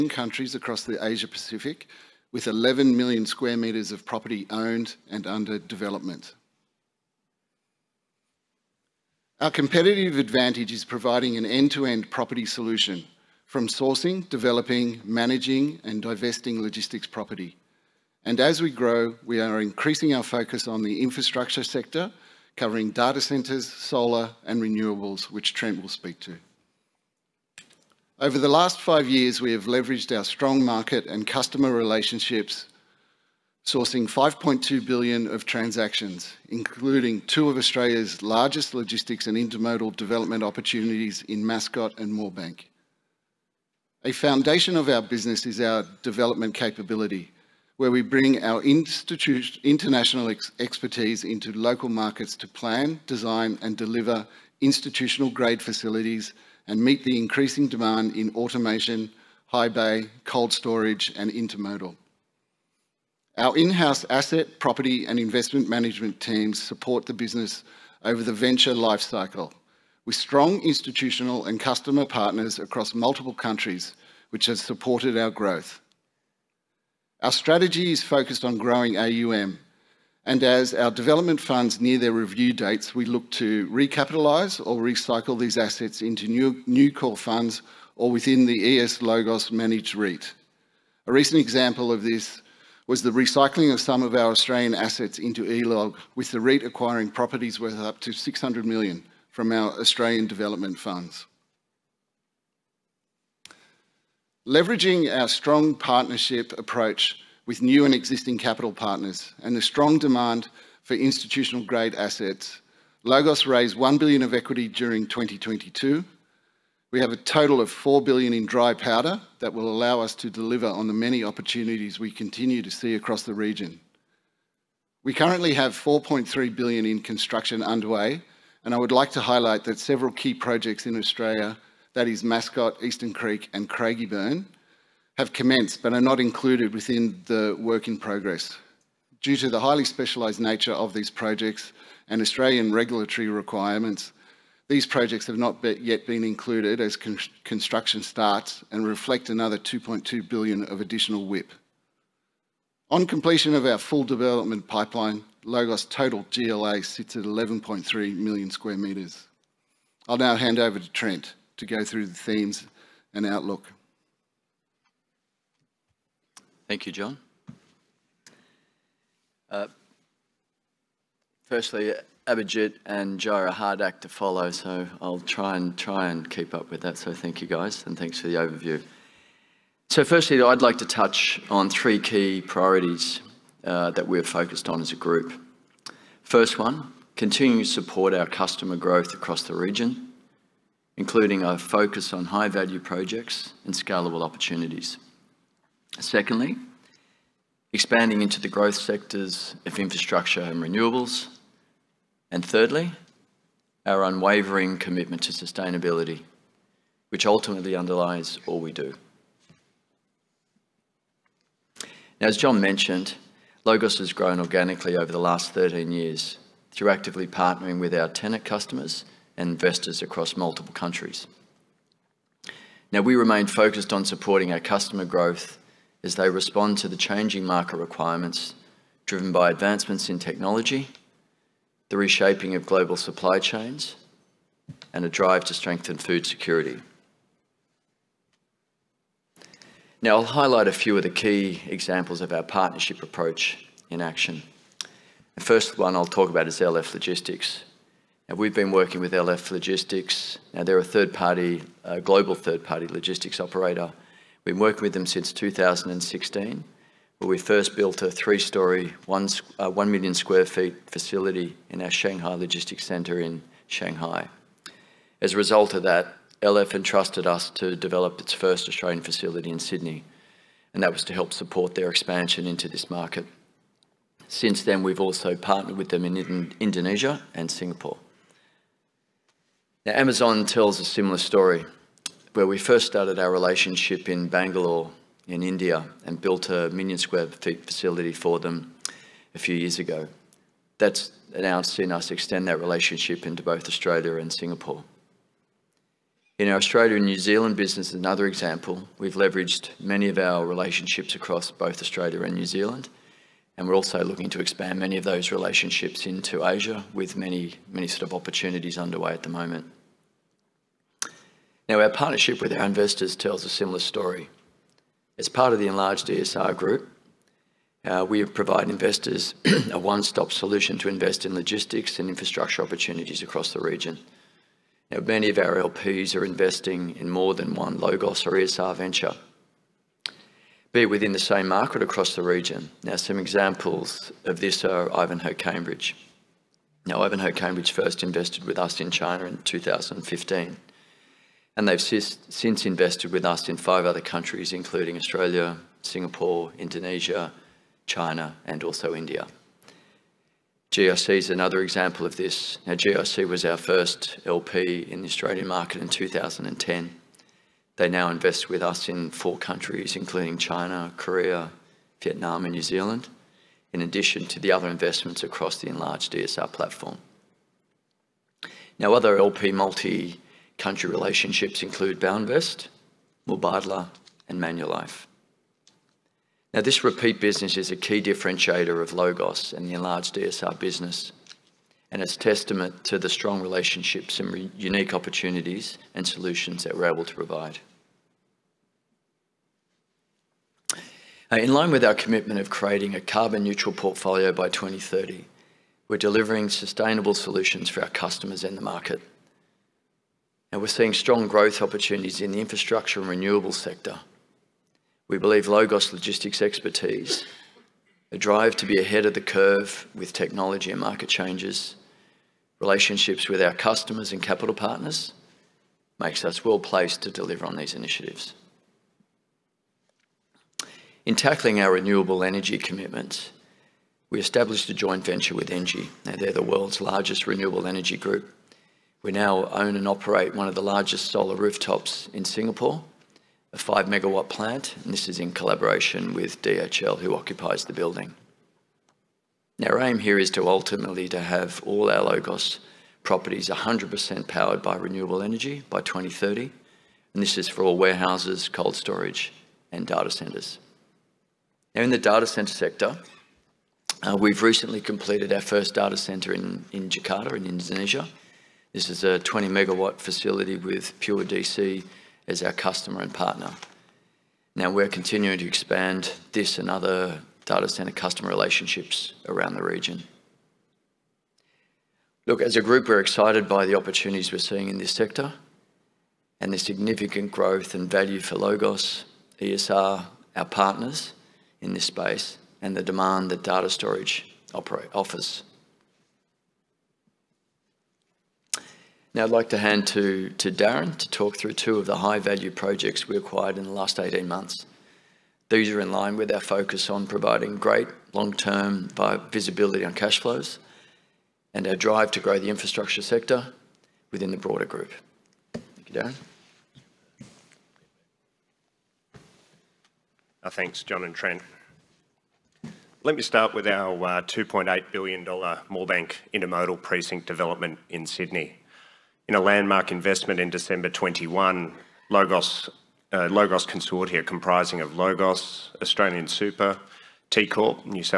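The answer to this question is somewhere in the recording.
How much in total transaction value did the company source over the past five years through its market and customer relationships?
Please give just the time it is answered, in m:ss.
0:34.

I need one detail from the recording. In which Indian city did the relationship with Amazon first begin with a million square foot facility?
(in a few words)
Bangalore.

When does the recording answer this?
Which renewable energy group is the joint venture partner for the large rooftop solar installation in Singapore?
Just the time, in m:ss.
7:05.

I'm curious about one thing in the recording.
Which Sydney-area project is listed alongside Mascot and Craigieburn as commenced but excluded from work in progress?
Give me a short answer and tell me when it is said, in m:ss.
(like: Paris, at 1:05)
Eastern Creek, at 2:12.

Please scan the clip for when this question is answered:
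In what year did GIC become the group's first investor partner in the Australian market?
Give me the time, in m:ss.
5:55.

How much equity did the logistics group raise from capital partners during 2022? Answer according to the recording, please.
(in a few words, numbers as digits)
1 billion.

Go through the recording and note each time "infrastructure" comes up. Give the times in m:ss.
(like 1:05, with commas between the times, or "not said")
0:21, 3:19, 5:22, 6:42, 8:22.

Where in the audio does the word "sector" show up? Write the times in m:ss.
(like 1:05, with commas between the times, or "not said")
0:21, 3:18, 6:43, 7:32, 7:54, 8:23.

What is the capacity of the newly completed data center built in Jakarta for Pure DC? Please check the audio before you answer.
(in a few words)
20 megawatts.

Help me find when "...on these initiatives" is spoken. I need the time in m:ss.
6:57.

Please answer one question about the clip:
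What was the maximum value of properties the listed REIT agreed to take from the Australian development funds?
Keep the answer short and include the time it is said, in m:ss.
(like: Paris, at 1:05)
600 million, at 1:38.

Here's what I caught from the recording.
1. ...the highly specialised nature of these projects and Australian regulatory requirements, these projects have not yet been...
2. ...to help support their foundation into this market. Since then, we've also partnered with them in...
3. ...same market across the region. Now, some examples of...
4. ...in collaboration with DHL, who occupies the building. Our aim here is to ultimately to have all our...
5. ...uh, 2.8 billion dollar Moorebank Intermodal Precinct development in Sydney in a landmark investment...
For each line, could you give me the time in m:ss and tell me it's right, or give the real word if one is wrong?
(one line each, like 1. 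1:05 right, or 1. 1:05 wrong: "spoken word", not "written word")
1. 2:19 right
2. 4:31 wrong: "expansion", not "foundation"
3. 5:31 right
4. 7:15 right
5. 8:33 right.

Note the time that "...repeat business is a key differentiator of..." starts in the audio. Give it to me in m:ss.
6:16.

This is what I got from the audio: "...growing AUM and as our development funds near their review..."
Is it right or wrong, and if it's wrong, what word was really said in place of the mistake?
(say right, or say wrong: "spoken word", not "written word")
right.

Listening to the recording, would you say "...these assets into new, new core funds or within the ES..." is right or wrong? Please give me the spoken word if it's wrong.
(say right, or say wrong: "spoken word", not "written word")
right.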